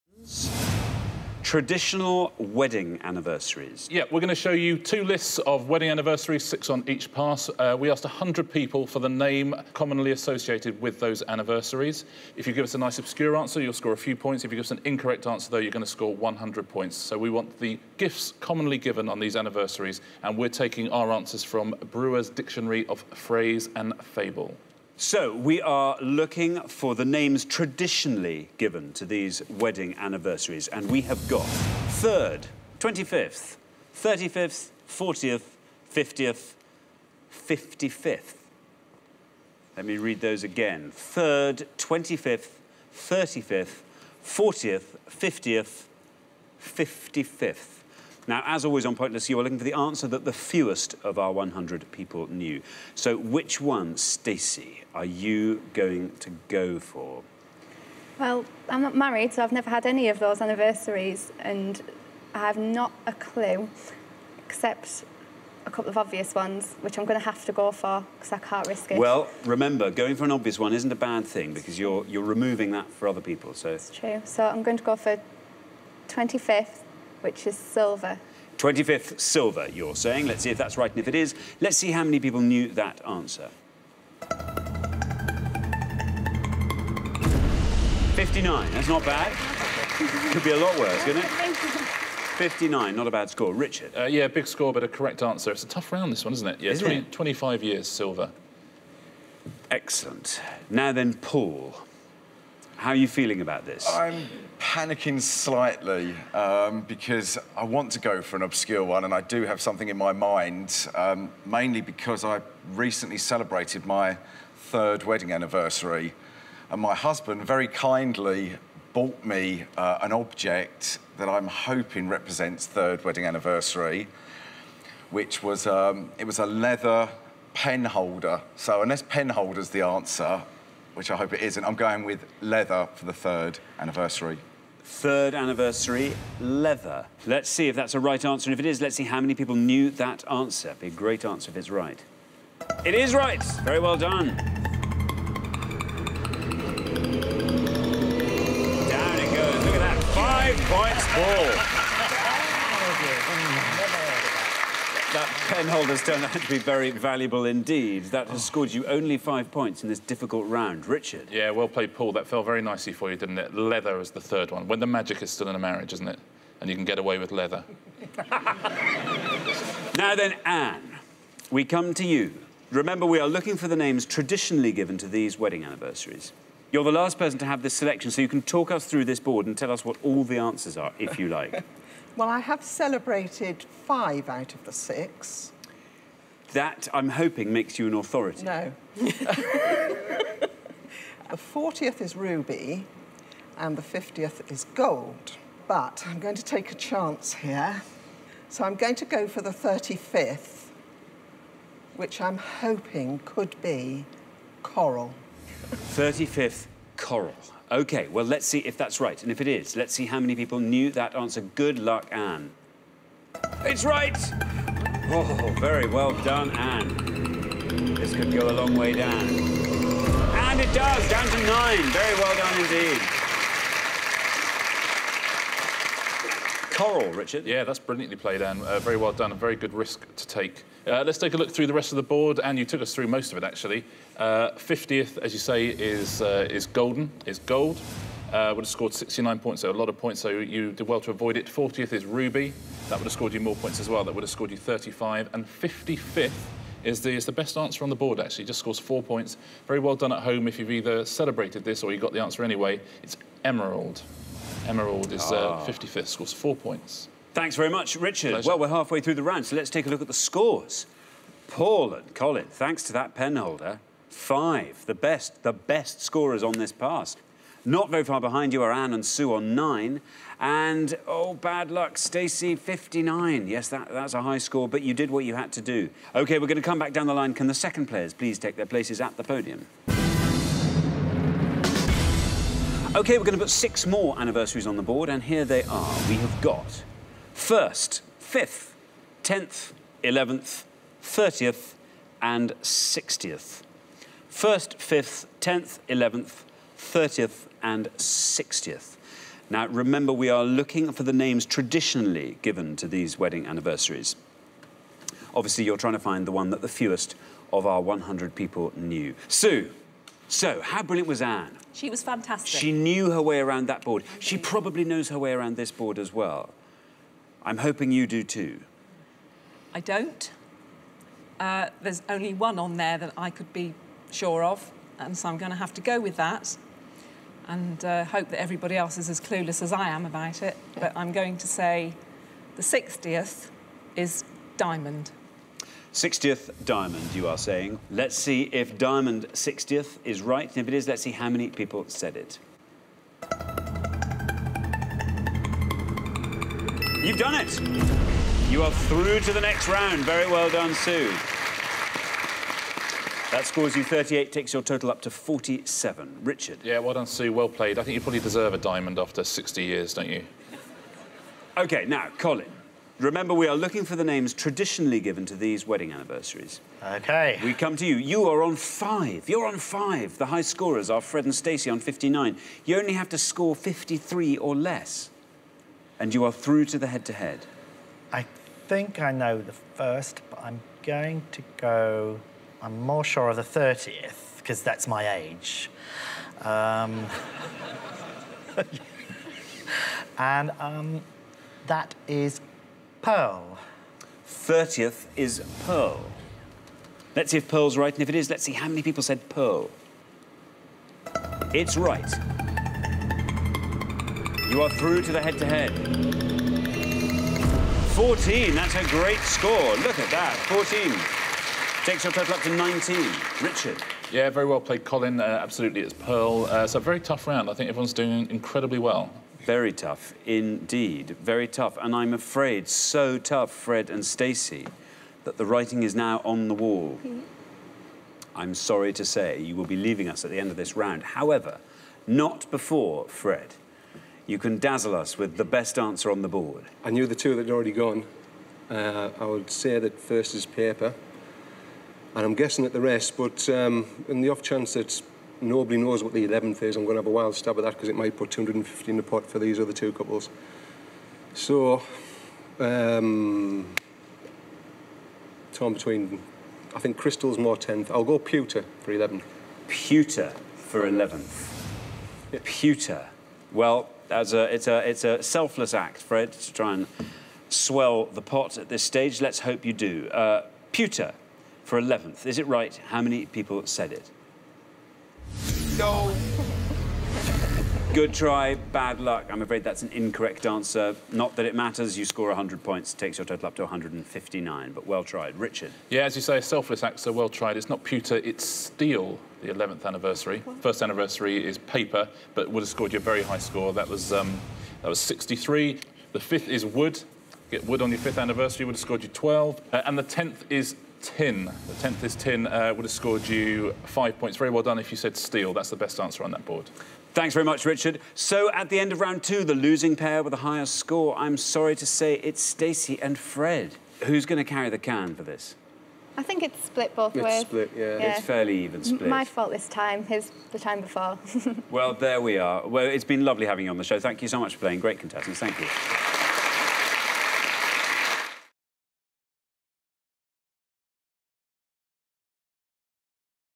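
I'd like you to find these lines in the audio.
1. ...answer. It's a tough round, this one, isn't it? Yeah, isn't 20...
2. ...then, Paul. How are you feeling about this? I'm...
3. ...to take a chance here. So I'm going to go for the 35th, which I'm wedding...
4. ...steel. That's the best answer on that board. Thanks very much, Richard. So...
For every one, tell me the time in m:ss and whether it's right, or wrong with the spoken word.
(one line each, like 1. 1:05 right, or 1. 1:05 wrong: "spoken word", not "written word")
1. 1:35 right
2. 1:40 right
3. 3:16 wrong: "hoping", not "wedding"
4. 8:25 right.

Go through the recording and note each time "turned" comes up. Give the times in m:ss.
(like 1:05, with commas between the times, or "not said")
2:36.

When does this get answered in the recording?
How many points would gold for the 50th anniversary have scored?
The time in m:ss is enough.
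3:58.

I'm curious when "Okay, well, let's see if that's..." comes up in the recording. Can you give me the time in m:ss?
3:27.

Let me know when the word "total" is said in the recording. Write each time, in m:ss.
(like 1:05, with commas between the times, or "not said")
5:54, 6:52, 8:03.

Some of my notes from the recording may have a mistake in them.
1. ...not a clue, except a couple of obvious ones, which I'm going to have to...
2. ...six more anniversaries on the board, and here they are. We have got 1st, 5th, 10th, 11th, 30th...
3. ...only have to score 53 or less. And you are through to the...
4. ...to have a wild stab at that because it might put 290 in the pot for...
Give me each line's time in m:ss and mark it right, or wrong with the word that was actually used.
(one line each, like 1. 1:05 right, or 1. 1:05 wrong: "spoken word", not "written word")
1. 1:02 right
2. 4:43 right
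3. 6:12 right
4. 7:26 wrong: "250", not "290".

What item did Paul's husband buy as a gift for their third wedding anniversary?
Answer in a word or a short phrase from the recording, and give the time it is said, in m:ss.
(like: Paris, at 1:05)
leather pen holder, at 2:06.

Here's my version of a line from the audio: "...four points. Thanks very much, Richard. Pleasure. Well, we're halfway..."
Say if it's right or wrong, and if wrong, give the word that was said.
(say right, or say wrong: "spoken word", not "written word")
right.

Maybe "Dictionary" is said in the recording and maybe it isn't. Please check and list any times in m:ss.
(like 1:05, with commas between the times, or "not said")
0:22.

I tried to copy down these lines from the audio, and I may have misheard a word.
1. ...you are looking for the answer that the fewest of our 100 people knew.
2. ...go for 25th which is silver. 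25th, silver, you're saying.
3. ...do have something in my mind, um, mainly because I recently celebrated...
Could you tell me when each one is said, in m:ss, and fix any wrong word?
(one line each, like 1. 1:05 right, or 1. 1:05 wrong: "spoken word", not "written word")
1. 0:49 right
2. 1:14 right
3. 1:49 right.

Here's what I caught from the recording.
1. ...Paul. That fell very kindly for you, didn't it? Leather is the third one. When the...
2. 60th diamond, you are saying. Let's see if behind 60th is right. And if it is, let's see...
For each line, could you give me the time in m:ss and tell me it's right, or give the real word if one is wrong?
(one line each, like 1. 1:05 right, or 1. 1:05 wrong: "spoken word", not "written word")
1. 2:41 wrong: "nicely", not "kindly"
2. 5:35 wrong: "diamond", not "behind".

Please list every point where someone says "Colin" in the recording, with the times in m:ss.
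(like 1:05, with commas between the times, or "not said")
4:22, 6:02, 6:54.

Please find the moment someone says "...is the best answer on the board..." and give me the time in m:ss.
4:07.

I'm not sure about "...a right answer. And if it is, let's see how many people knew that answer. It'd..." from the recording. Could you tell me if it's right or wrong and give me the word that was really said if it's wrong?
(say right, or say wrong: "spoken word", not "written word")
right.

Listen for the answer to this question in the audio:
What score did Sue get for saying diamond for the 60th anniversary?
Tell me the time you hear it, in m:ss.
5:53.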